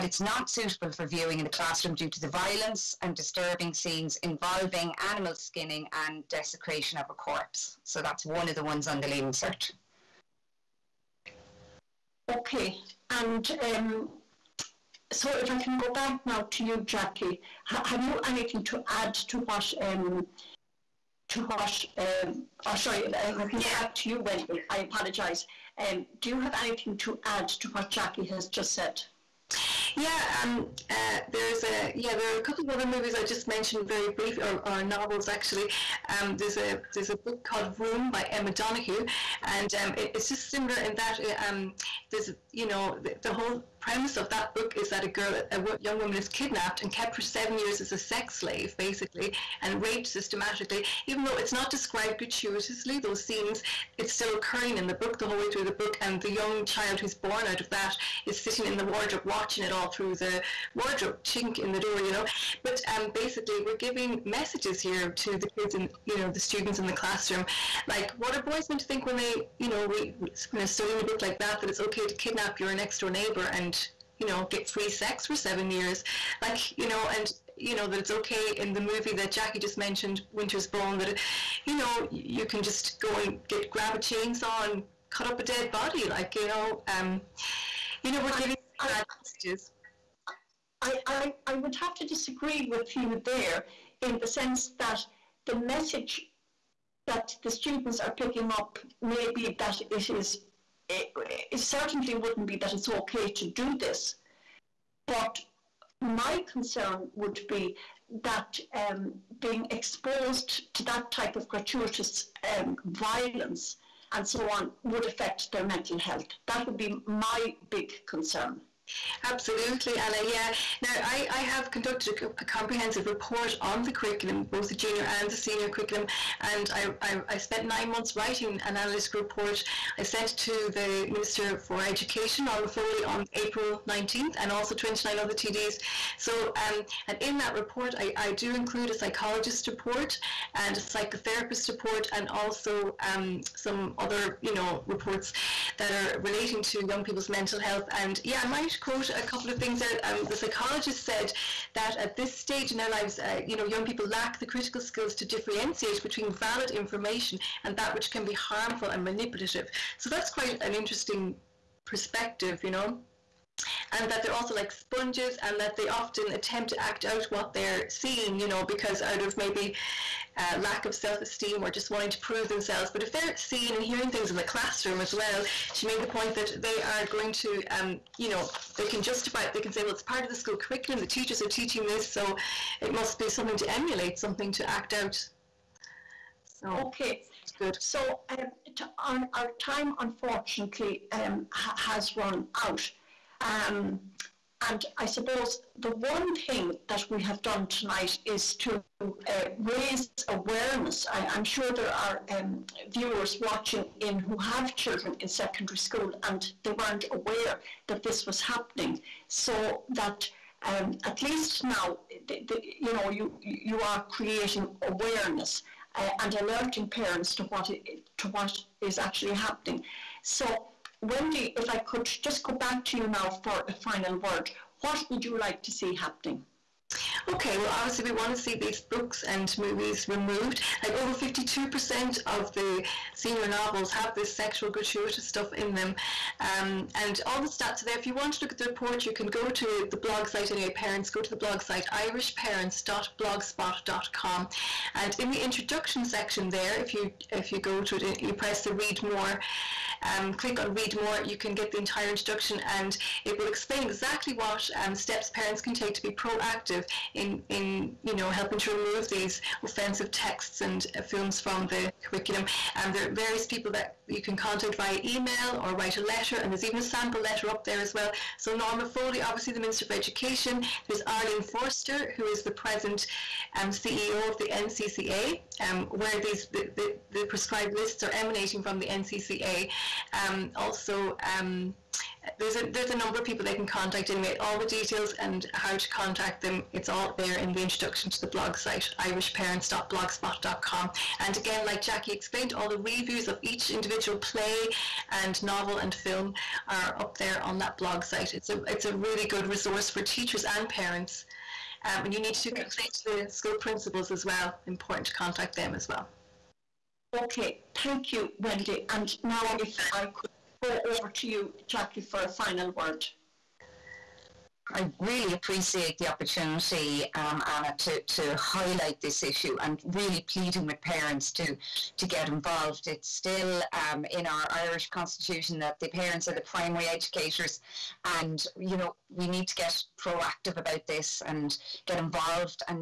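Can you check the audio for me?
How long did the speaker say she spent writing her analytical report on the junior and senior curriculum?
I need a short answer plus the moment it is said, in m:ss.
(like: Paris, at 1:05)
9 months, at 2:07.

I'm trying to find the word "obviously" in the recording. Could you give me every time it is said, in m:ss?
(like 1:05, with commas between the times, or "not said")
3:47, 4:29.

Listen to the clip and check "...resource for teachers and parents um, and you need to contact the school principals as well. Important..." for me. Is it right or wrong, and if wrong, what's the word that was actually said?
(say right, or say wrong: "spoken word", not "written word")
right.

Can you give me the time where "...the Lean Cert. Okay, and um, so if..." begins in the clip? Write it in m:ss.
0:08.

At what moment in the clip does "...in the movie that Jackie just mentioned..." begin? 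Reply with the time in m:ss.
1:18.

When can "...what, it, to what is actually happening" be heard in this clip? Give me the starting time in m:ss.
3:37.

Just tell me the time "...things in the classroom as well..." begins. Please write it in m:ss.
2:54.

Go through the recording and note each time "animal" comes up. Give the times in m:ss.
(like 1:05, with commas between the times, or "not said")
0:05.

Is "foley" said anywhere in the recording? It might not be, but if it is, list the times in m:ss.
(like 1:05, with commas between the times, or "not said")
2:12, 4:28.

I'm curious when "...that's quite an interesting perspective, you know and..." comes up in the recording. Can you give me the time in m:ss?
2:40.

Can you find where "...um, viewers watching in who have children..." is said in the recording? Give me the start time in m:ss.
3:22.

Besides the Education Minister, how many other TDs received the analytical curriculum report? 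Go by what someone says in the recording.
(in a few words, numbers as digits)
29.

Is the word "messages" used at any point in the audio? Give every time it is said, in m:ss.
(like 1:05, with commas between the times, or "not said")
1:04, 1:29, 1:35.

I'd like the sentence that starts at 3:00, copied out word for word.
The teachers are teaching this, so it must be something to emulate, something to act out.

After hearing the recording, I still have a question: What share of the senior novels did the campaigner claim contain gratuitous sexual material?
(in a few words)
52%.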